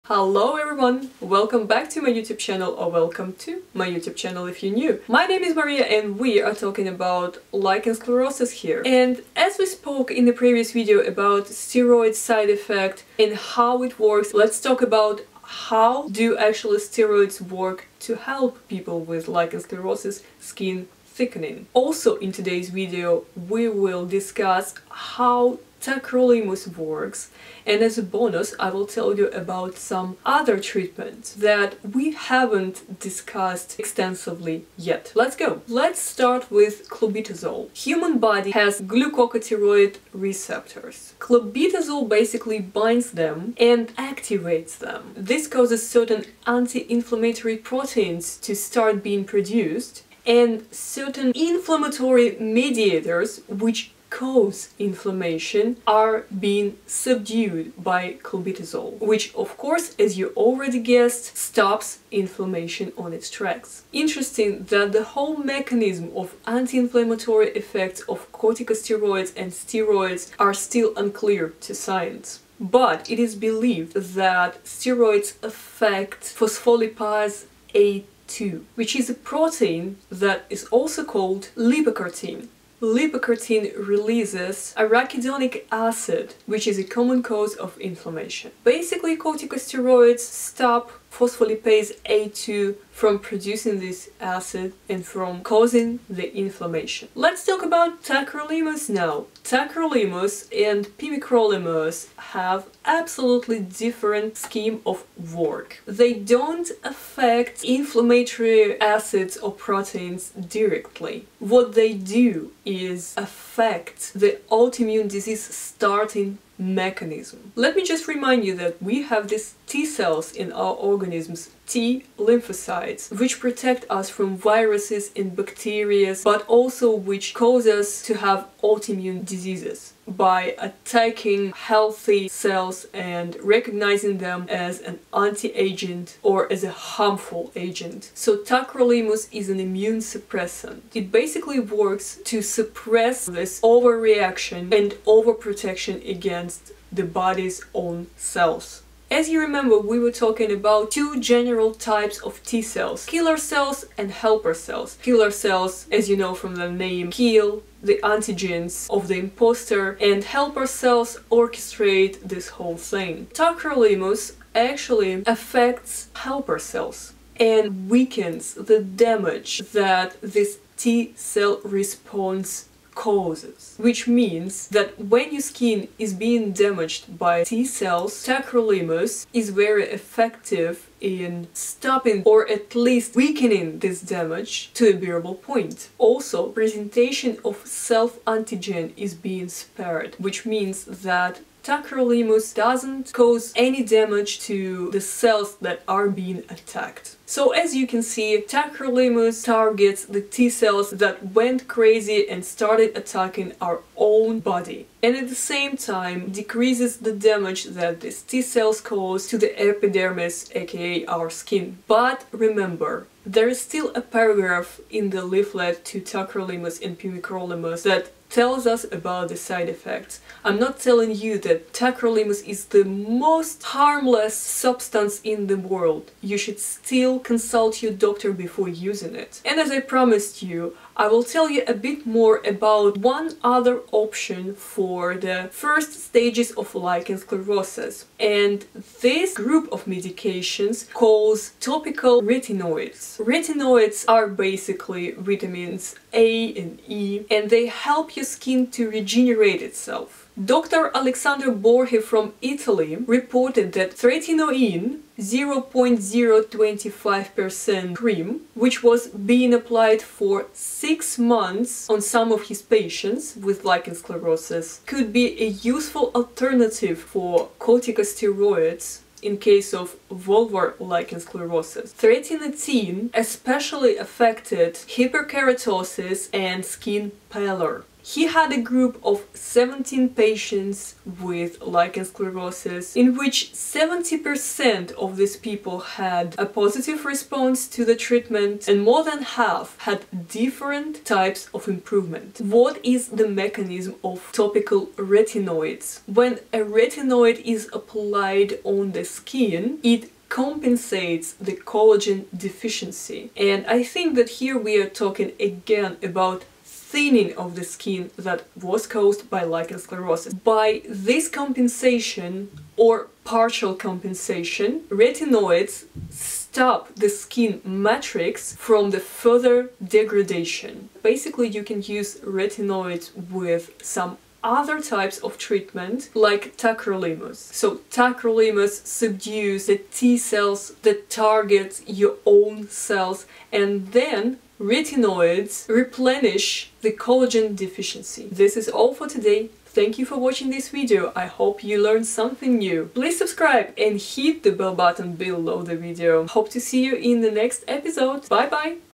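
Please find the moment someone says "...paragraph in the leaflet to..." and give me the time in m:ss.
3:34.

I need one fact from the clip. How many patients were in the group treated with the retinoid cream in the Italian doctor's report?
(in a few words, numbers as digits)
17.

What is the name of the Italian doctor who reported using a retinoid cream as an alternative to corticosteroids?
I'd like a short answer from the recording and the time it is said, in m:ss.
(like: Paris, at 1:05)
Alexander Borghi, at 4:10.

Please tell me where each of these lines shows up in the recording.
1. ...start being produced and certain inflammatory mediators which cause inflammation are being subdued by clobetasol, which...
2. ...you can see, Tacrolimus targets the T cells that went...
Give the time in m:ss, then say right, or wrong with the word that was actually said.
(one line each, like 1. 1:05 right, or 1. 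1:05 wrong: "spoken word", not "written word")
1. 0:48 right
2. 3:17 right.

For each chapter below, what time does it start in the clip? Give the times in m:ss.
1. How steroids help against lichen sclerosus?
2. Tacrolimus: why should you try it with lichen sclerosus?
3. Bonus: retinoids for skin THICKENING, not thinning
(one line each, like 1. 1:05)
1. 0:17
2. 1:37
3. 3:49.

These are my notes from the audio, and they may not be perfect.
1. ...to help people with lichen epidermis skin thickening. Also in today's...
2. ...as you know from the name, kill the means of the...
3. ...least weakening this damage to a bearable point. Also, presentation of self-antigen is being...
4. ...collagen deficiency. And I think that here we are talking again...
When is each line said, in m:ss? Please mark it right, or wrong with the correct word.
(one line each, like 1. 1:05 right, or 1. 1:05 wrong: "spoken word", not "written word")
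1. 0:18 wrong: "sclerosis", not "epidermis"
2. 2:35 wrong: "antigens", not "means"
3. 3:02 right
4. 5:01 right.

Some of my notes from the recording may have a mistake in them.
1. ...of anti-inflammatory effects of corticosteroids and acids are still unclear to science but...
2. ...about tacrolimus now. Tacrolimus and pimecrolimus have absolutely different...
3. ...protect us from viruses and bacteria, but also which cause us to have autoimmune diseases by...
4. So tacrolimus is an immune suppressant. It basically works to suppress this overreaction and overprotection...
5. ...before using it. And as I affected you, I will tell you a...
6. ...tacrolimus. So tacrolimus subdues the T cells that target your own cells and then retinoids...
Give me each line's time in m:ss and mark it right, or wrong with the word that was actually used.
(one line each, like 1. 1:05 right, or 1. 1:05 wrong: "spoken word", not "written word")
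1. 1:06 wrong: "steroids", not "acids"
2. 1:37 right
3. 2:03 right
4. 2:18 right
5. 3:48 wrong: "promised", not "affected"
6. 5:26 right.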